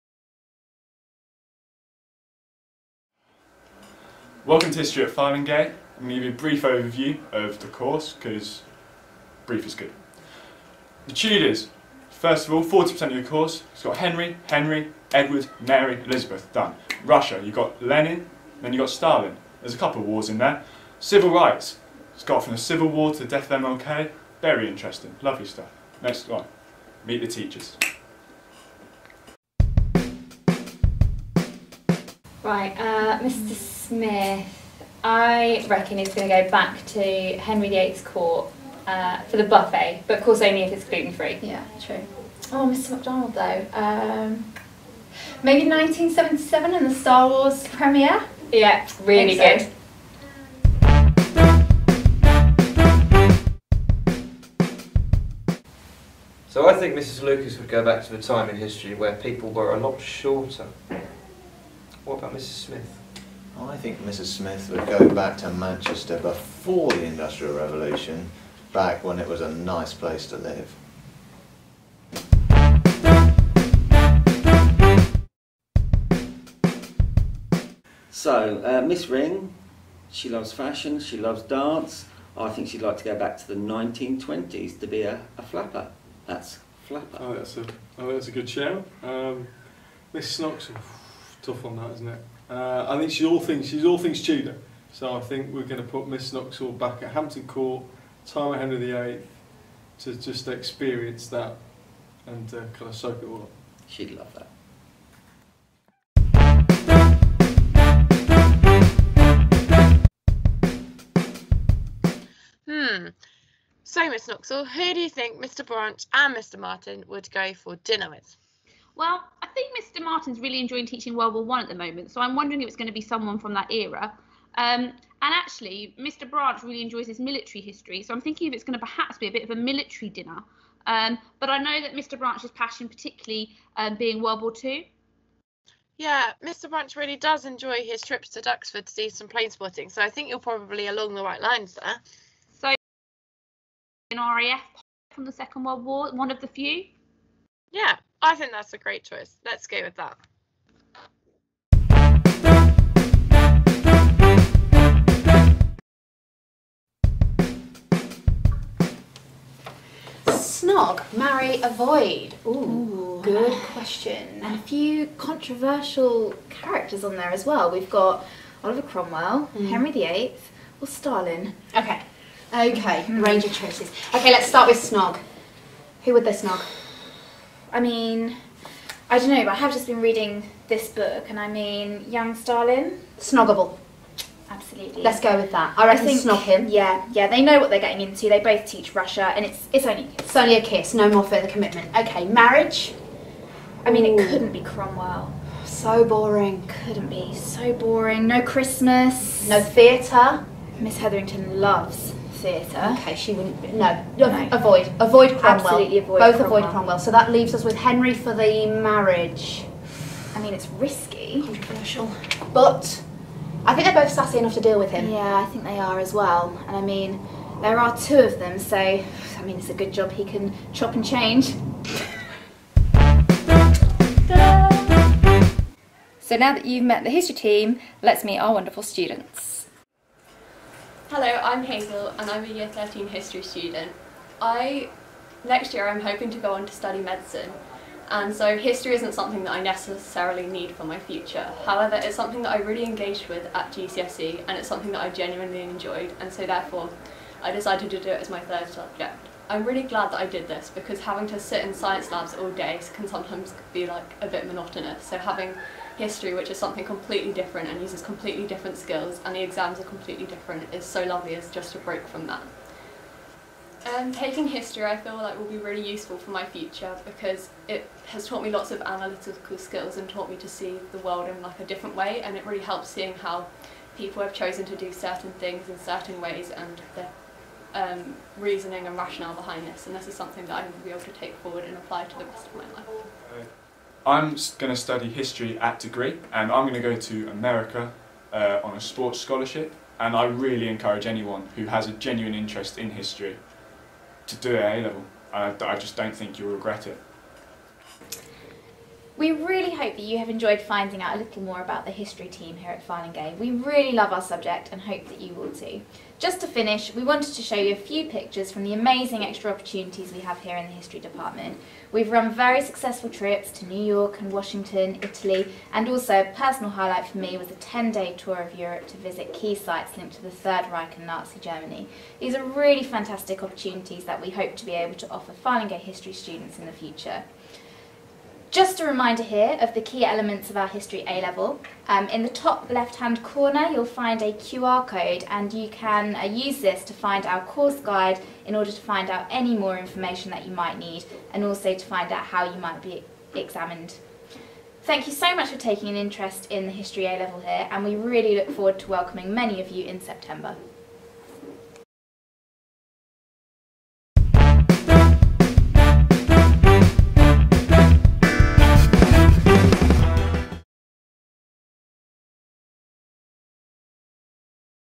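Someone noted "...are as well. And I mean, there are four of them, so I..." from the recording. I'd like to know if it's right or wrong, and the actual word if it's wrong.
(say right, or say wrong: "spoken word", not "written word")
wrong: "two", not "four".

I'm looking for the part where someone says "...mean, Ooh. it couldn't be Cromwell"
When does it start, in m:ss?
3:13.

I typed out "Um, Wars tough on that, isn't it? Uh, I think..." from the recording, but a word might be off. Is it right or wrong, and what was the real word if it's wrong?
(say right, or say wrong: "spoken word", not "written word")
wrong: "Miss", not "Wars".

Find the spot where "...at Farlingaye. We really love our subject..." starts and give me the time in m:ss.
5:02.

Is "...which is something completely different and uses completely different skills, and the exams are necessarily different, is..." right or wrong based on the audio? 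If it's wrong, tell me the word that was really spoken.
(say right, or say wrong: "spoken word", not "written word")
wrong: "completely", not "necessarily".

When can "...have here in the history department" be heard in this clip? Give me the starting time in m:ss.
5:10.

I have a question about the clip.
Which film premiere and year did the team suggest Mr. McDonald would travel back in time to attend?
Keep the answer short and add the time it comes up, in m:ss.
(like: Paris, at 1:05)
1977 Star Wars premiere, at 0:45.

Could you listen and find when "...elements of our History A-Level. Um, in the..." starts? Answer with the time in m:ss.
5:30.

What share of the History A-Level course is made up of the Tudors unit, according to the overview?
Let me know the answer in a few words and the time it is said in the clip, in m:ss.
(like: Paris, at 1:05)
40%, at 0:12.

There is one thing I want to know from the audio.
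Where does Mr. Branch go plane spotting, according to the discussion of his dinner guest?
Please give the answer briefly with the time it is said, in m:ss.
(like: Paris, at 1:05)
Duxford, at 2:18.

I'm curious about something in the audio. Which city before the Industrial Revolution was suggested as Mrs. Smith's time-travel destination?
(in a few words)
Manchester.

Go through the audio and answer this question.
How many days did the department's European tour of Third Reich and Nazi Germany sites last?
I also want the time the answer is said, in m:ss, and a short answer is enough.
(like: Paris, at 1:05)
10, at 5:17.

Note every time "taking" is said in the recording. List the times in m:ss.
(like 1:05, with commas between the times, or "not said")
4:24, 5:45.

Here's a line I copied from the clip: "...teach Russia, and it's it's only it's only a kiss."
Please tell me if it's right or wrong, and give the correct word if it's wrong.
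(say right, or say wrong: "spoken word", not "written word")
right.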